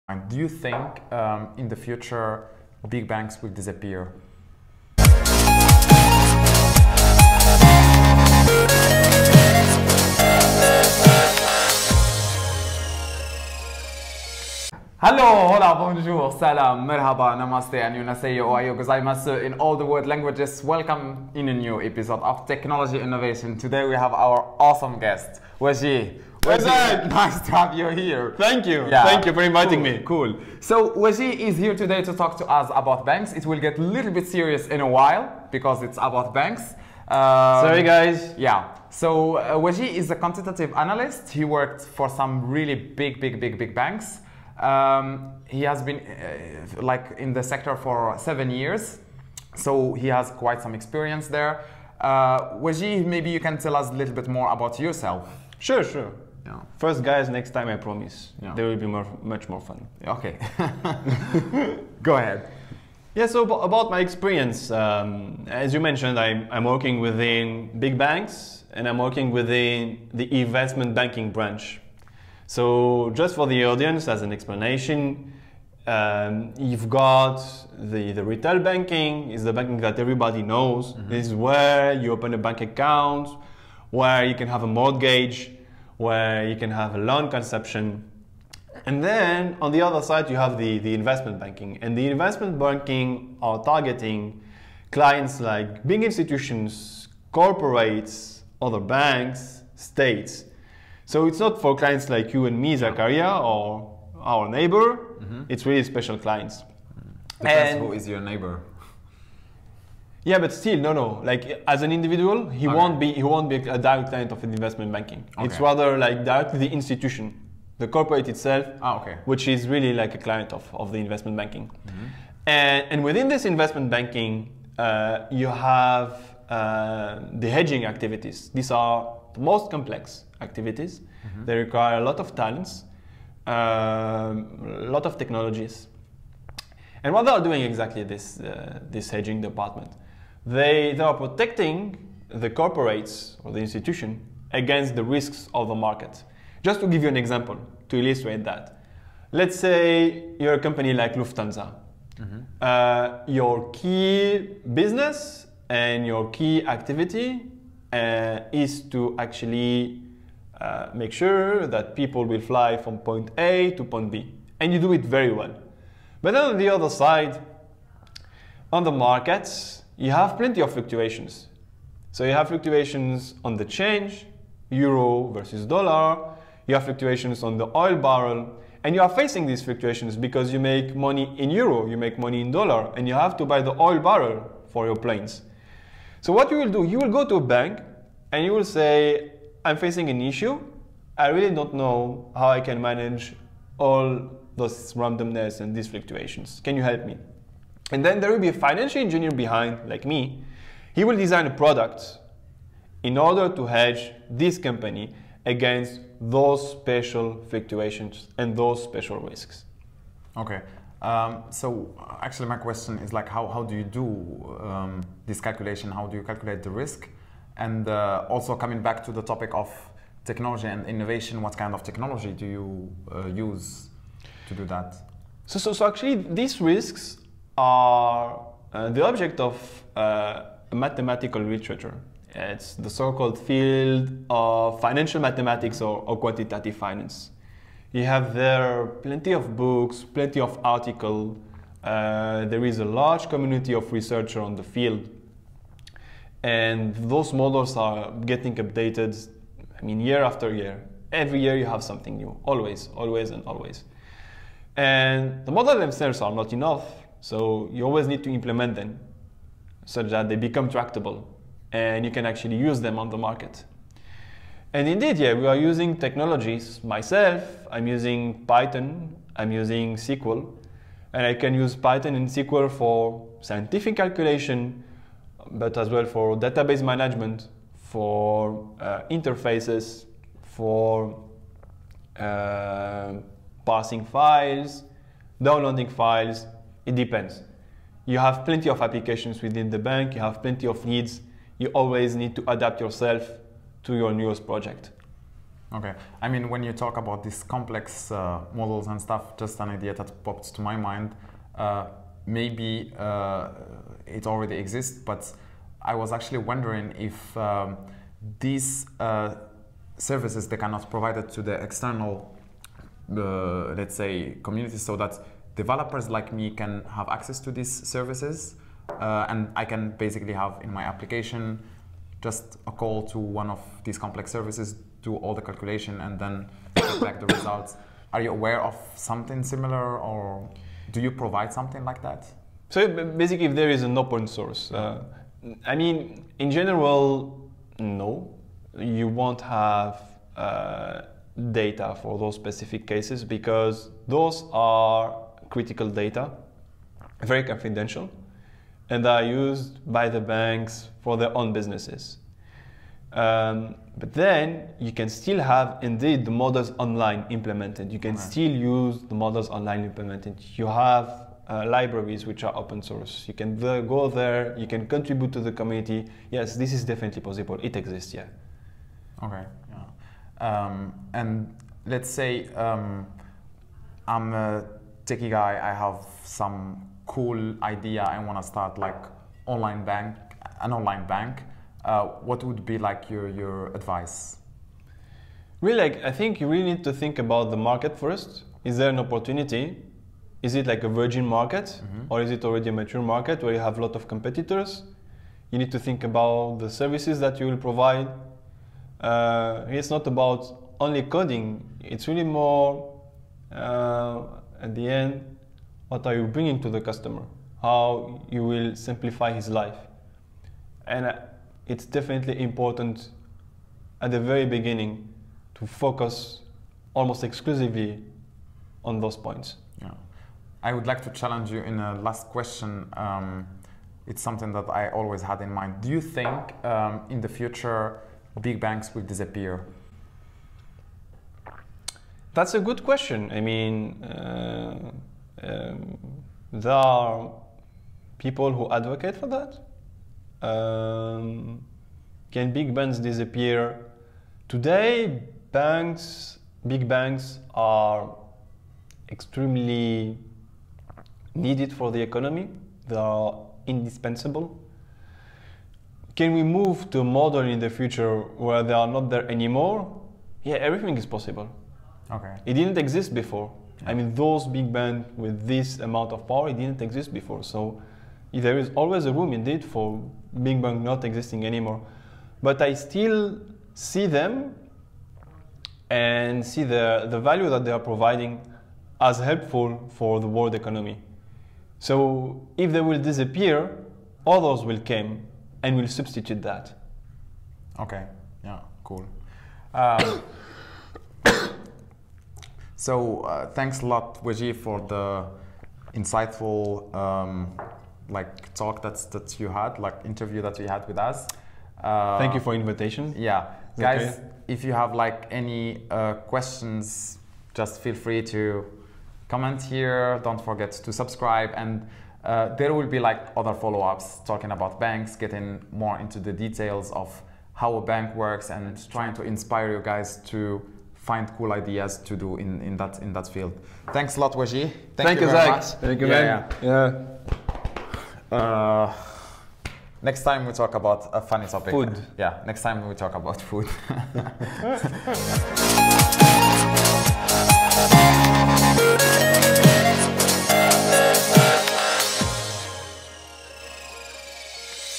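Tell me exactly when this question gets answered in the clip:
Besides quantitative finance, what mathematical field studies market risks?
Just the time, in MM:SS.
03:54.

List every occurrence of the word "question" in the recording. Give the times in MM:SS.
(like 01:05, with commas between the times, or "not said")
03:32, 07:02, 07:12, 08:26.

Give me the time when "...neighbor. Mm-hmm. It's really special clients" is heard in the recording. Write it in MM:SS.
01:44.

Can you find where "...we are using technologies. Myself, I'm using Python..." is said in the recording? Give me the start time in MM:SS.
04:25.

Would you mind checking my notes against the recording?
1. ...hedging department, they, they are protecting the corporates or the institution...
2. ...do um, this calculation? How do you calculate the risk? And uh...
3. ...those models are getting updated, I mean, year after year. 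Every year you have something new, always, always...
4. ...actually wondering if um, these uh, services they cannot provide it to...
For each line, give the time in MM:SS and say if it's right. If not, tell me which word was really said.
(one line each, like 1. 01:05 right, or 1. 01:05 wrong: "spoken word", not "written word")
1. 02:19 right
2. 03:33 right
3. 04:07 right
4. 05:06 right.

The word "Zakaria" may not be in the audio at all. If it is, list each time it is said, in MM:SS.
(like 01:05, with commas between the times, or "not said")
01:42.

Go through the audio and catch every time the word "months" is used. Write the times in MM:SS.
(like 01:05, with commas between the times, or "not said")
not said.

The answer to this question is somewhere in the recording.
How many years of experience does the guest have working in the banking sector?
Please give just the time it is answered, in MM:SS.
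00:48.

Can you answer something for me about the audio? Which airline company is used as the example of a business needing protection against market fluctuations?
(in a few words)
Lufthansa.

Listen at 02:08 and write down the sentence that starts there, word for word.
These are the most complex activities.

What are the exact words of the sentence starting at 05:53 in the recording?
Um, but then you can still have indeed the models online implemented.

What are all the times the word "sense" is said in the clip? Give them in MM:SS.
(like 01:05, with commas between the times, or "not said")
not said.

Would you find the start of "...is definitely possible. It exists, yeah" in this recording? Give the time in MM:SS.
06:06.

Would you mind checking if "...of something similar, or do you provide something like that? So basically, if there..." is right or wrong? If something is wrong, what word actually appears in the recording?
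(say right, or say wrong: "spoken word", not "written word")
right.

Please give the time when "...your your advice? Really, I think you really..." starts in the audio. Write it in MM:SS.
06:23.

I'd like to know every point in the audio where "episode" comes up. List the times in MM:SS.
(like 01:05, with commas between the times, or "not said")
00:21.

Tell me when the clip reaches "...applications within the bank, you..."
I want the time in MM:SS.
04:48.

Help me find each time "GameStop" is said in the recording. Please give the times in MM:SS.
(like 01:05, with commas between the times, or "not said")
not said.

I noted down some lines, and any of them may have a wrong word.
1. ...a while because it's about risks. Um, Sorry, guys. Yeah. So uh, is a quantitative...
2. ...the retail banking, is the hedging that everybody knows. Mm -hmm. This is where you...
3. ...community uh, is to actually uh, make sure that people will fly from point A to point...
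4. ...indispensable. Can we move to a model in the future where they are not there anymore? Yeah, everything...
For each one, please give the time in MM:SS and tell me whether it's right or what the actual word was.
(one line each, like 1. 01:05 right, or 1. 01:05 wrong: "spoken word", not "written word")
1. 00:34 wrong: "banks", not "risks"
2. 01:18 wrong: "banking", not "hedging"
3. 02:36 wrong: "activity", not "community"
4. 07:33 right.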